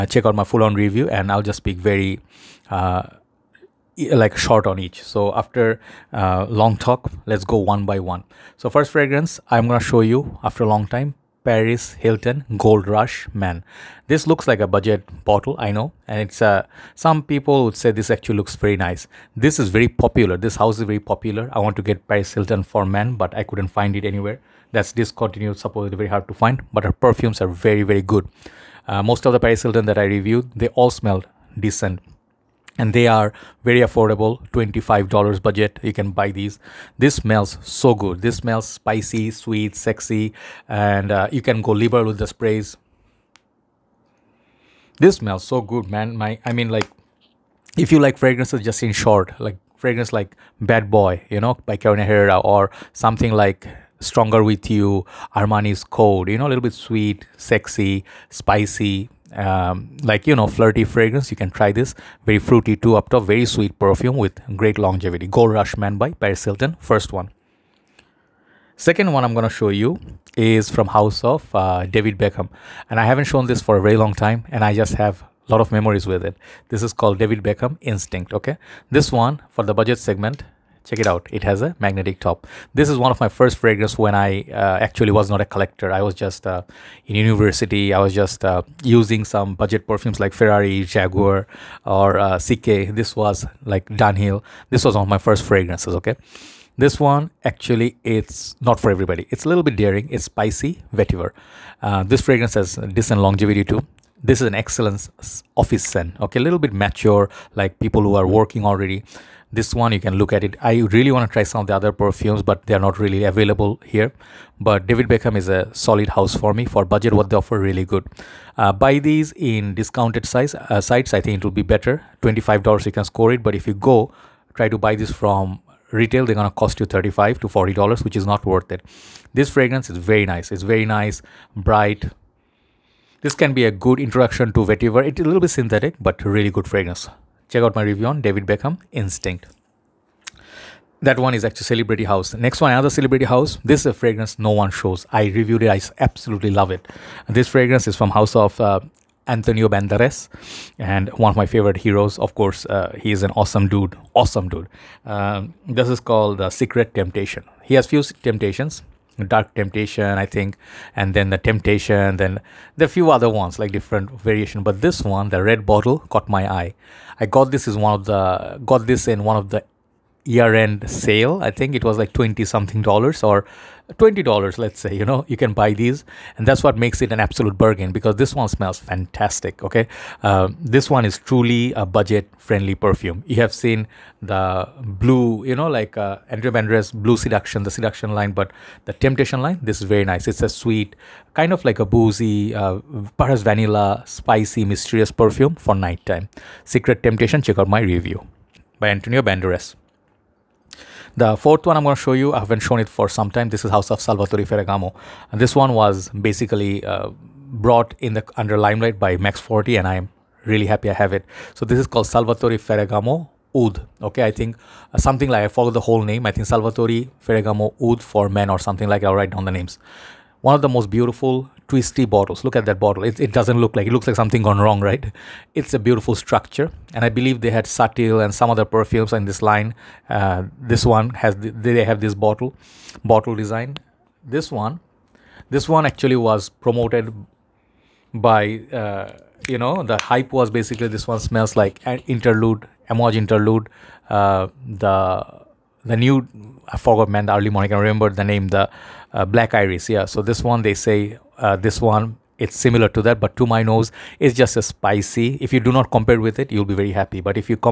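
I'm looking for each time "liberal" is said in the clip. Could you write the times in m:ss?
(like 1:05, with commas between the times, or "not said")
0:41.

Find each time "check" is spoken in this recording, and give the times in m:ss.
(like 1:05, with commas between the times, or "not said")
0:00, 1:20, 2:17, 3:17.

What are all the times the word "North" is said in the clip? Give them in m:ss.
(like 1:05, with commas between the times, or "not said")
not said.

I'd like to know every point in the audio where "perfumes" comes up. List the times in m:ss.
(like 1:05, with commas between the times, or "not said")
0:26, 1:03, 1:29, 1:51, 3:02, 3:15, 3:48.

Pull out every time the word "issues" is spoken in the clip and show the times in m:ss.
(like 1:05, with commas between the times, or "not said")
not said.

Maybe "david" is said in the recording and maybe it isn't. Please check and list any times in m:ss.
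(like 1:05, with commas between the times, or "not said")
1:11, 1:17, 1:54, 2:18.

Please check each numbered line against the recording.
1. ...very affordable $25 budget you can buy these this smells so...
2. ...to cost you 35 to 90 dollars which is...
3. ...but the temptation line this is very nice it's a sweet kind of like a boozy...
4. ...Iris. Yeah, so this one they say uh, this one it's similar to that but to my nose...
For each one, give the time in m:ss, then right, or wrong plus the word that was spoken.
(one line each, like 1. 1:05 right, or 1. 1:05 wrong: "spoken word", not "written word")
1. 0:33 right
2. 2:06 wrong: "40", not "90"
3. 3:08 right
4. 4:09 right.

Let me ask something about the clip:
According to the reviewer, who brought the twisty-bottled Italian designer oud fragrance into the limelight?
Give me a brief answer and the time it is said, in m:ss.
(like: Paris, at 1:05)
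Max 40, at 3:29.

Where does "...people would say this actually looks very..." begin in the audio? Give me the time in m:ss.
0:17.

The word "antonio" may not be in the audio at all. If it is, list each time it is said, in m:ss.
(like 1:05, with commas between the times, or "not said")
2:29, 3:18.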